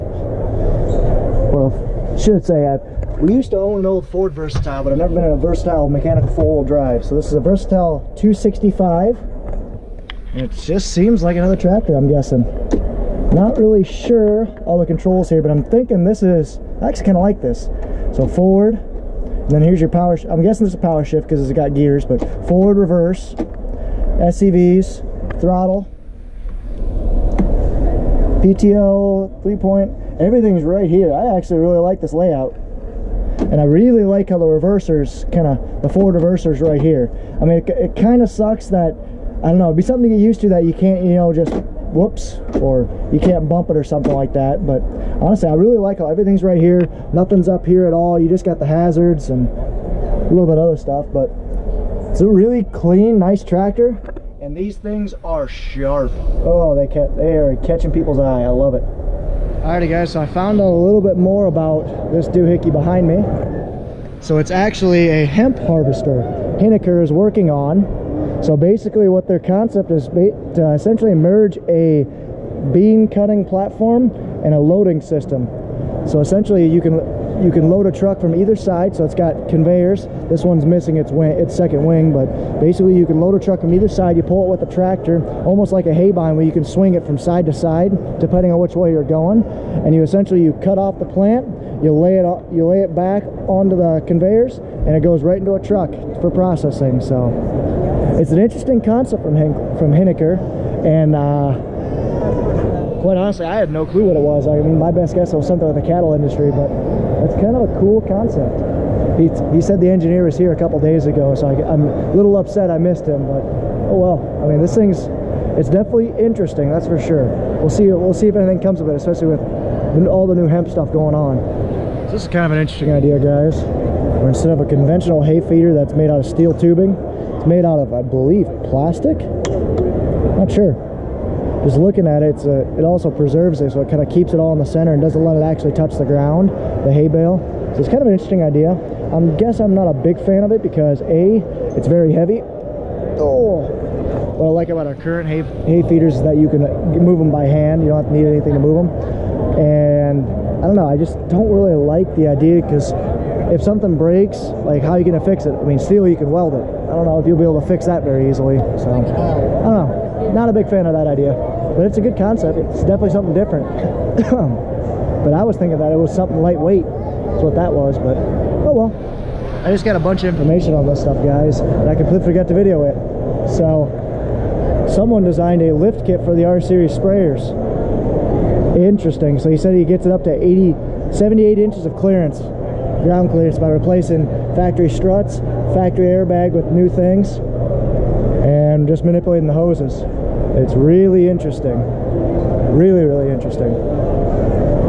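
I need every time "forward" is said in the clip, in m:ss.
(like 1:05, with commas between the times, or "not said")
0:18, 0:22.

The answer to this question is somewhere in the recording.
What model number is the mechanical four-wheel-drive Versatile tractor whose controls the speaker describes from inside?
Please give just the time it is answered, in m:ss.
0:07.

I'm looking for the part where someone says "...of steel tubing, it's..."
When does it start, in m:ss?
2:06.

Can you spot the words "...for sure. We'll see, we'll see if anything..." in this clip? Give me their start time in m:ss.
1:56.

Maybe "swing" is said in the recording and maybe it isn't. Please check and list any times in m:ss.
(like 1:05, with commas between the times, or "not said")
1:26.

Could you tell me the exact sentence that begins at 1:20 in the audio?
This one's missing its wing, its second wing, but basically you can load a truck from either side.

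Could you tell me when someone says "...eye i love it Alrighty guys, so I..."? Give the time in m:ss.
0:58.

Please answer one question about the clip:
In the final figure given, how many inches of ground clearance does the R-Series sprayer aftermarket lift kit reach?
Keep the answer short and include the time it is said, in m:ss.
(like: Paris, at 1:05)
78 inches, at 3:01.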